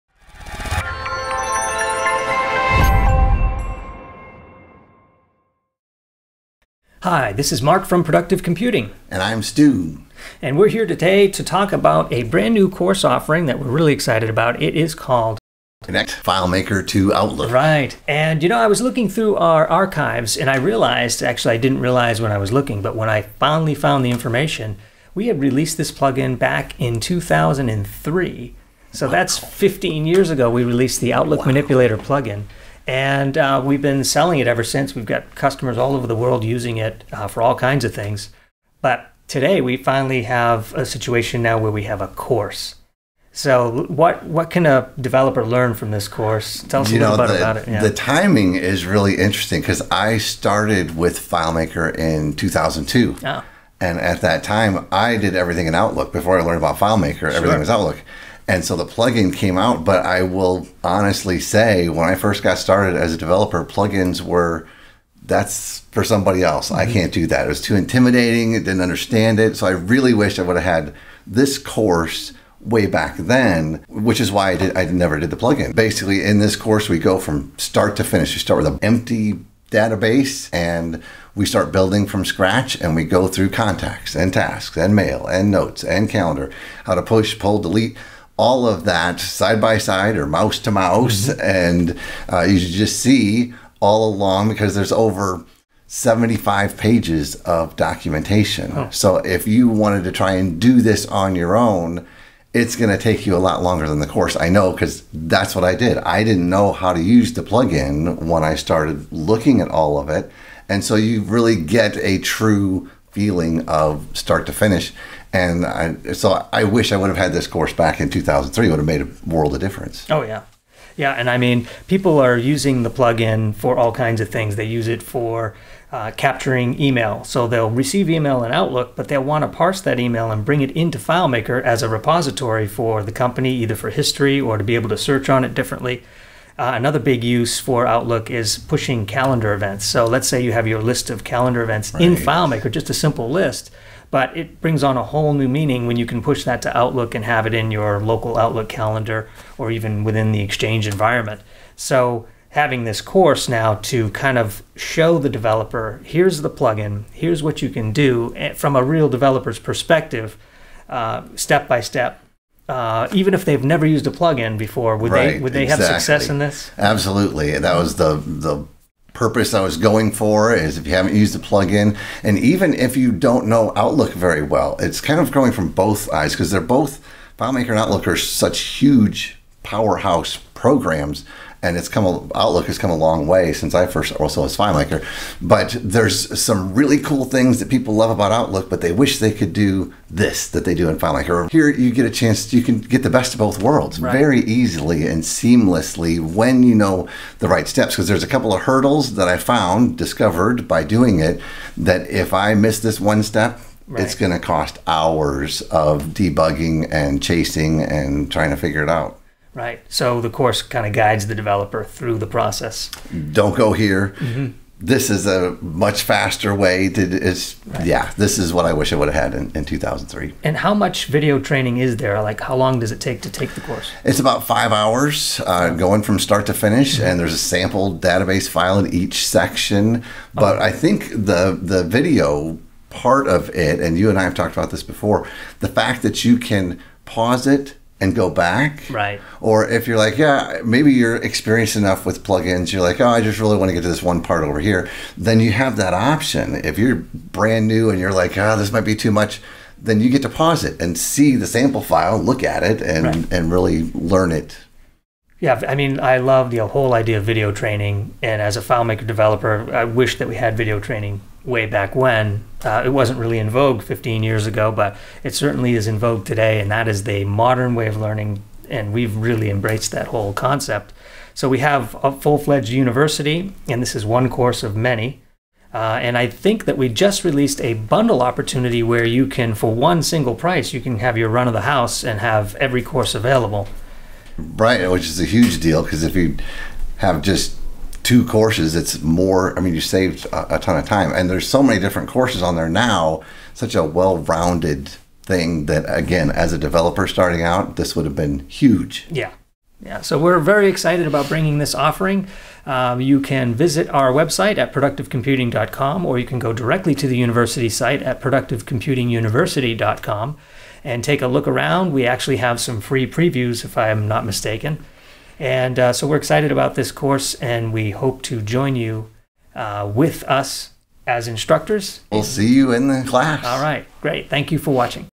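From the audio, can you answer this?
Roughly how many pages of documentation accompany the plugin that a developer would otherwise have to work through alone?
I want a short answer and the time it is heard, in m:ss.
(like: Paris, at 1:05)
75, at 1:35.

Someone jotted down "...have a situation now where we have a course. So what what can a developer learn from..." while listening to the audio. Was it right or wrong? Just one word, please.
right.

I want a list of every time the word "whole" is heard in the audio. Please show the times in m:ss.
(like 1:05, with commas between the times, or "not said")
2:25, 4:16, 4:30.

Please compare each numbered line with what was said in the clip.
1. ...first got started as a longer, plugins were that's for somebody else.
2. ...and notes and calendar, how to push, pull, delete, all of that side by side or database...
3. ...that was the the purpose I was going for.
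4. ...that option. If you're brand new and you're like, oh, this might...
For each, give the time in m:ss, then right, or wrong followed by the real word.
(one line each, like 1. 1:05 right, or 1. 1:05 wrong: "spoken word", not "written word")
1. 1:02 wrong: "developer", not "longer"
2. 1:25 wrong: "mouse", not "database"
3. 2:47 right
4. 4:05 right.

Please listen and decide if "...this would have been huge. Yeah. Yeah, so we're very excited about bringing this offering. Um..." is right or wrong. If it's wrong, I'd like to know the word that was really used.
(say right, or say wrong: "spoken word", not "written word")
right.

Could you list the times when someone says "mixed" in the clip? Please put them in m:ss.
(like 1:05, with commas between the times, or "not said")
not said.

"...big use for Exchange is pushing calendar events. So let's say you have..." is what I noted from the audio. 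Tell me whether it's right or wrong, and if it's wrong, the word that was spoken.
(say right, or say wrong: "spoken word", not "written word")
wrong: "Outlook", not "Exchange".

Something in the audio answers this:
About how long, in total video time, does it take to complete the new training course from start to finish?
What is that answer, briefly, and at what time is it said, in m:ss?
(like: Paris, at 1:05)
5 hours, at 3:44.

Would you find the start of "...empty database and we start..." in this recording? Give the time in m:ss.
1:18.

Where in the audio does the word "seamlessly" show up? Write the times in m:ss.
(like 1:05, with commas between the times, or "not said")
3:15.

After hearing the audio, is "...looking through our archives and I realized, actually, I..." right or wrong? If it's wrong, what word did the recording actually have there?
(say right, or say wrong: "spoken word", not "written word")
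right.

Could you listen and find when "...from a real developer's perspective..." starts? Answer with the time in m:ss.
2:38.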